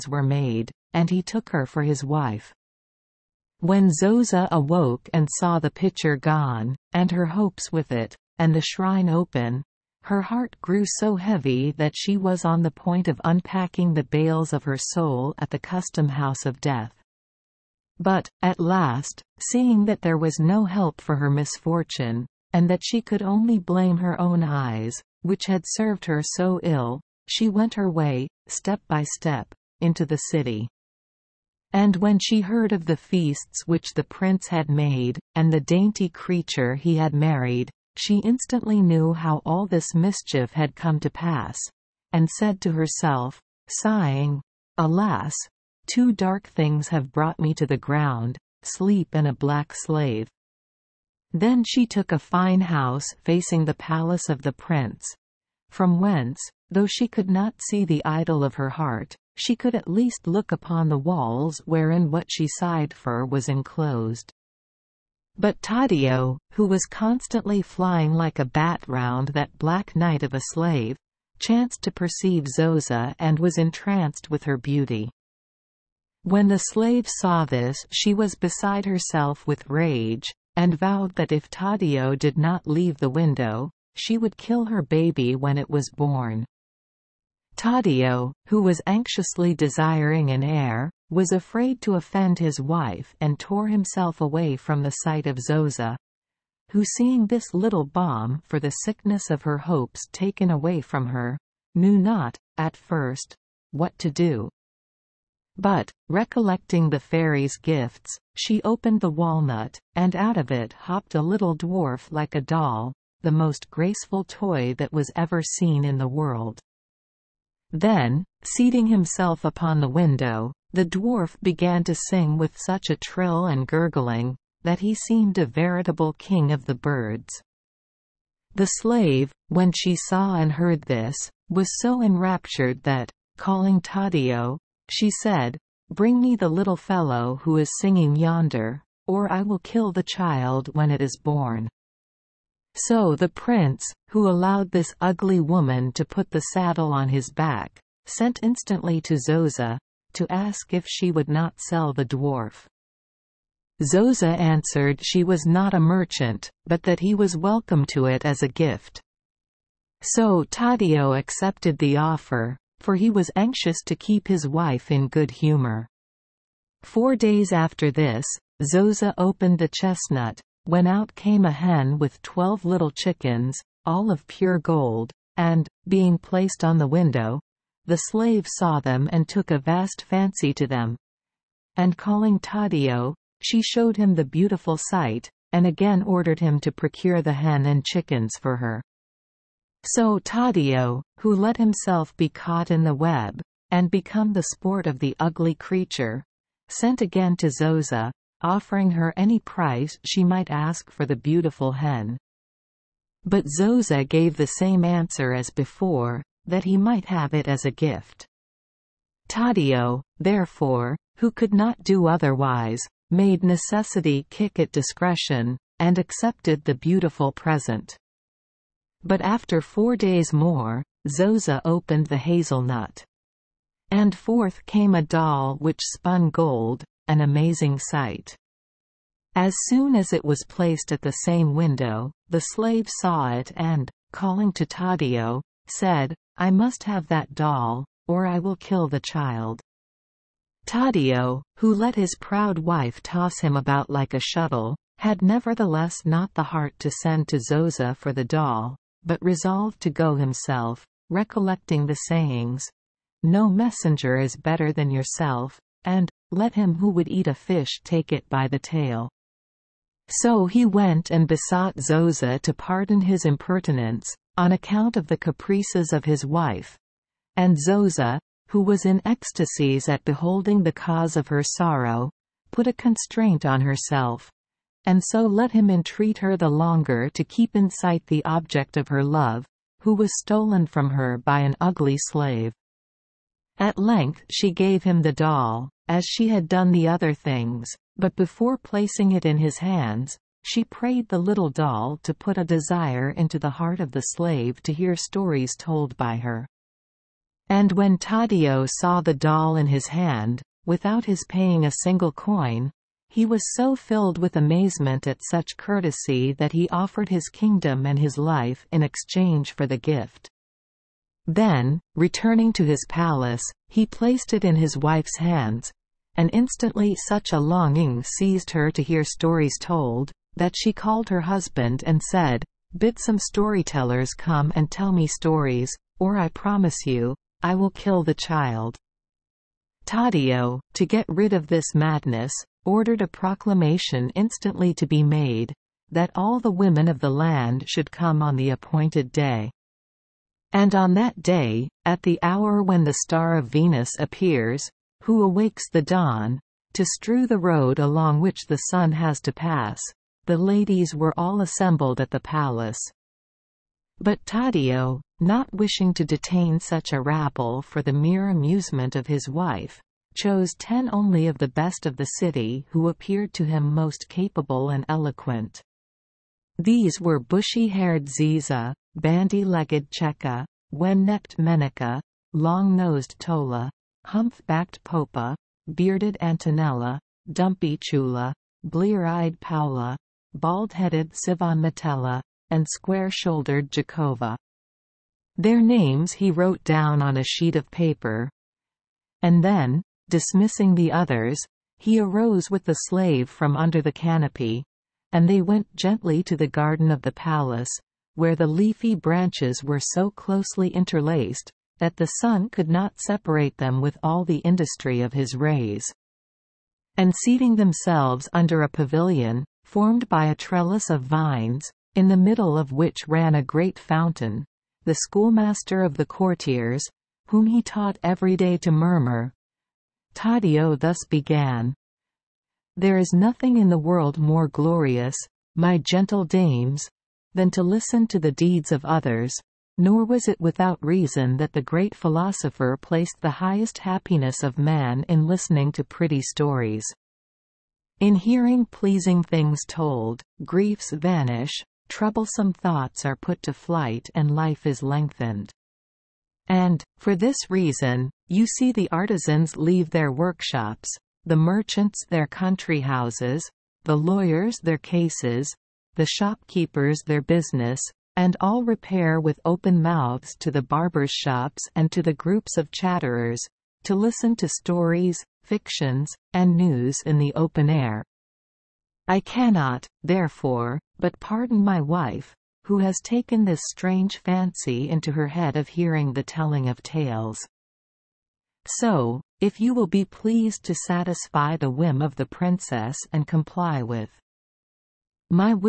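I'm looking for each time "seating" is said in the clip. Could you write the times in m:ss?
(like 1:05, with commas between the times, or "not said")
1:58, 6:47.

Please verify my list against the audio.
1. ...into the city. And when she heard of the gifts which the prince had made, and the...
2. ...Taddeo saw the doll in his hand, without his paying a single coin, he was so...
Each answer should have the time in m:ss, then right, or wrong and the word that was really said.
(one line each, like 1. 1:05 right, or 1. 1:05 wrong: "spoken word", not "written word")
1. 0:29 wrong: "feasts", not "gifts"
2. 4:57 right.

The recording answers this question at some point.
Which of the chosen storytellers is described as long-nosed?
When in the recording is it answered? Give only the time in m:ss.
6:13.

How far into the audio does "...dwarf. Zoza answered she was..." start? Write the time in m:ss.
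2:32.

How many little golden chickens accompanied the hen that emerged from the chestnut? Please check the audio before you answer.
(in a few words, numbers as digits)
12.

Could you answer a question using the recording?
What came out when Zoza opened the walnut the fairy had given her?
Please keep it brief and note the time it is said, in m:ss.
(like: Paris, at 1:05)
A little dwarf, at 1:51.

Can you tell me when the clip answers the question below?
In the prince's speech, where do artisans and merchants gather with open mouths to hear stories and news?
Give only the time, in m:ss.
7:40.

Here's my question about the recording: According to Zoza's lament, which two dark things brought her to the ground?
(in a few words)
Sleep and a black slave.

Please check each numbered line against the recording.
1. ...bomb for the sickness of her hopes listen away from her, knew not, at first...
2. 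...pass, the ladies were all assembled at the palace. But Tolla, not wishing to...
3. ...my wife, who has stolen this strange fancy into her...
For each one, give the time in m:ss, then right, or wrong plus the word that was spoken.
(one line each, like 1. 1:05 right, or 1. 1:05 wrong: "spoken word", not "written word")
1. 1:37 wrong: "taken", not "listen"
2. 5:49 wrong: "Taddeo", not "Tolla"
3. 7:51 wrong: "taken", not "stolen".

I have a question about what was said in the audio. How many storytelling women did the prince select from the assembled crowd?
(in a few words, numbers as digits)
10.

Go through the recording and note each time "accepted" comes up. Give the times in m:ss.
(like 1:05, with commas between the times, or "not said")
2:41, 3:35.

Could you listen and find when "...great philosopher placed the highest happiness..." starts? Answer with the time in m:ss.
7:11.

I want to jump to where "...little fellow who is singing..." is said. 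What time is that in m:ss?
2:16.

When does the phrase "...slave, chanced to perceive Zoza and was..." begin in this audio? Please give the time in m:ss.
1:10.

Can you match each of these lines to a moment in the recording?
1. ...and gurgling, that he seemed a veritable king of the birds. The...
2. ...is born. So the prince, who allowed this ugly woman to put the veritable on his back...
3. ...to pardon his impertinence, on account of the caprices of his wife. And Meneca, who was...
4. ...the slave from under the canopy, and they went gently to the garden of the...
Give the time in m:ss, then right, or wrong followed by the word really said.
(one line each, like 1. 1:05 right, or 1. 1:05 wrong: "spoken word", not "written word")
1. 2:03 right
2. 2:20 wrong: "saddle", not "veritable"
3. 4:22 wrong: "Zoza", not "Meneca"
4. 6:32 right.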